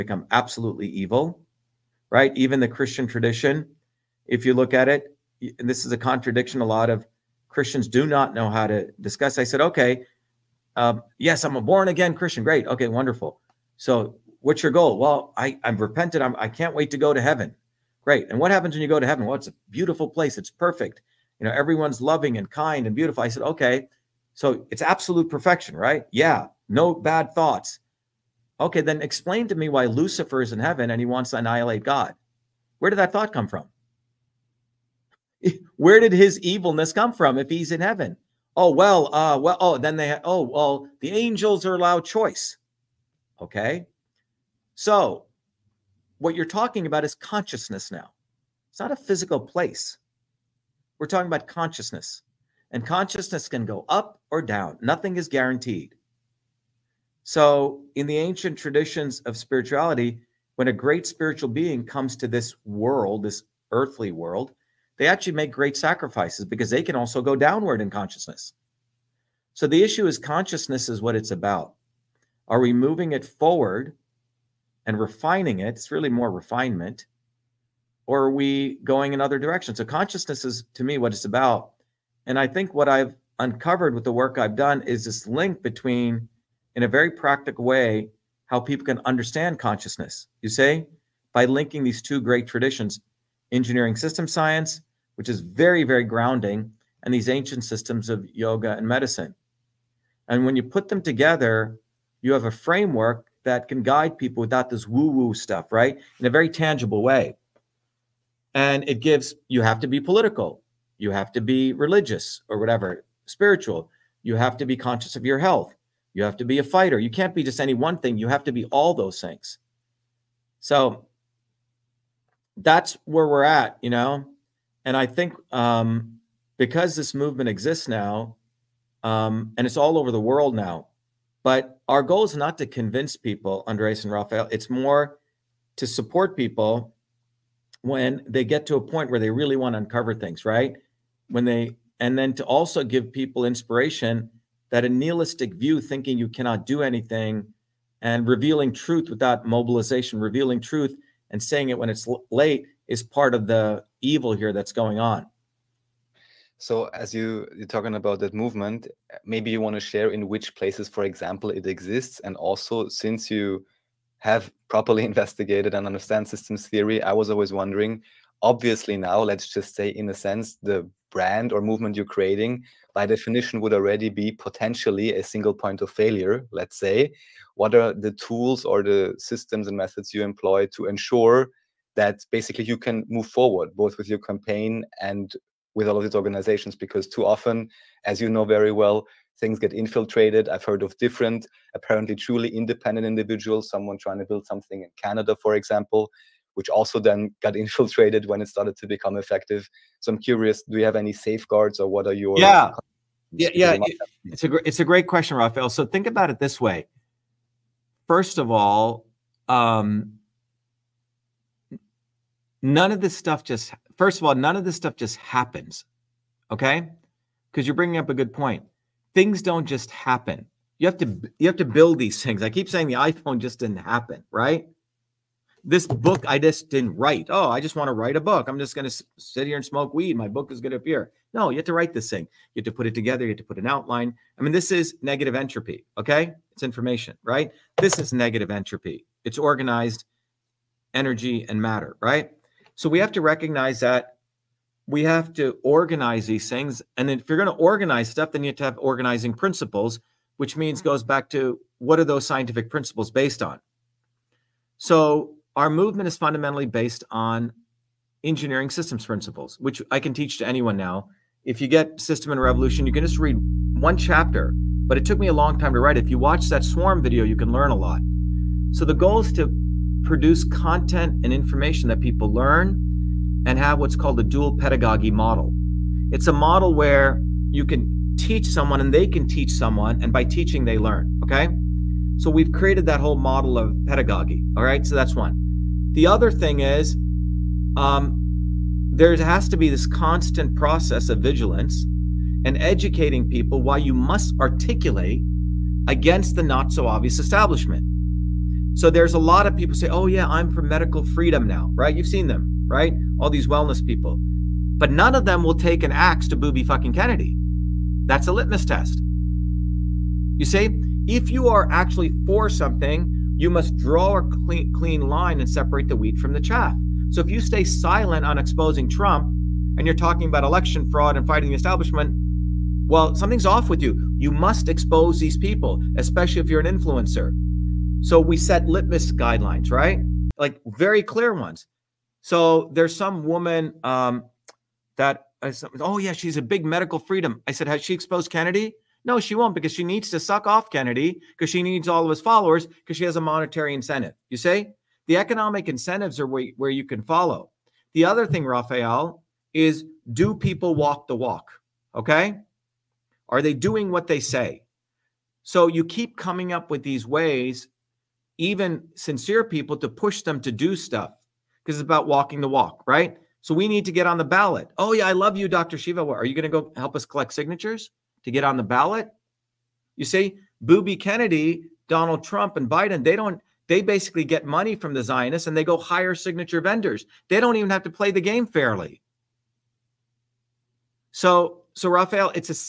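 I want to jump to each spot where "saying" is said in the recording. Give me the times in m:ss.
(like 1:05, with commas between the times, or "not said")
2:31, 3:42.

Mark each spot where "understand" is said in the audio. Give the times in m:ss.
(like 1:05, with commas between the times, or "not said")
1:29, 2:45.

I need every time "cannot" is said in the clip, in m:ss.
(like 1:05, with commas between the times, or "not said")
2:26.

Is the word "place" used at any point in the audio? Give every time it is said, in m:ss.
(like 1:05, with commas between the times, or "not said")
0:20, 0:49, 2:40.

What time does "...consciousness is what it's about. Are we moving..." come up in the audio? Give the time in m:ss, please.
1:10.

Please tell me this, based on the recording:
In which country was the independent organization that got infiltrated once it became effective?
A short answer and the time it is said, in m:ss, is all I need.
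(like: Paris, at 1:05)
Canada, at 3:15.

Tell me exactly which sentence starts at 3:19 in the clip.
So I'm curious, do you have any safeguards or what are your yeah yeah yeah it's a it's a great question, Raphael.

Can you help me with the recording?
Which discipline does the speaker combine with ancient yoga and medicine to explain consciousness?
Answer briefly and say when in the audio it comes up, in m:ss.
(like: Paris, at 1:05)
engineering system science, at 1:33.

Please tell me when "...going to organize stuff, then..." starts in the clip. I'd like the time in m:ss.
4:07.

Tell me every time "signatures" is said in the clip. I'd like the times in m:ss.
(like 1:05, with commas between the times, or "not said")
6:07, 6:16.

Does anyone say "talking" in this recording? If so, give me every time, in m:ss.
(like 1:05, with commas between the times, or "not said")
0:46, 0:51, 2:37, 5:19.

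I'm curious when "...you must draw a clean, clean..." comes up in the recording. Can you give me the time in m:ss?
5:13.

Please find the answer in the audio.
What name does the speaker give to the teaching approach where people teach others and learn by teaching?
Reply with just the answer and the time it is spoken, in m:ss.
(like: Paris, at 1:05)
dual pedagogy model, at 4:34.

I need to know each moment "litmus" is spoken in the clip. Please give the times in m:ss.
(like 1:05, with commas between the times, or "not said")
5:08, 5:28.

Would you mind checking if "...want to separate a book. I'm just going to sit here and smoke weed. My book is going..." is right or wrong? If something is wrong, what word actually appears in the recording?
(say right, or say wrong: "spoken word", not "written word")
wrong: "write", not "separate".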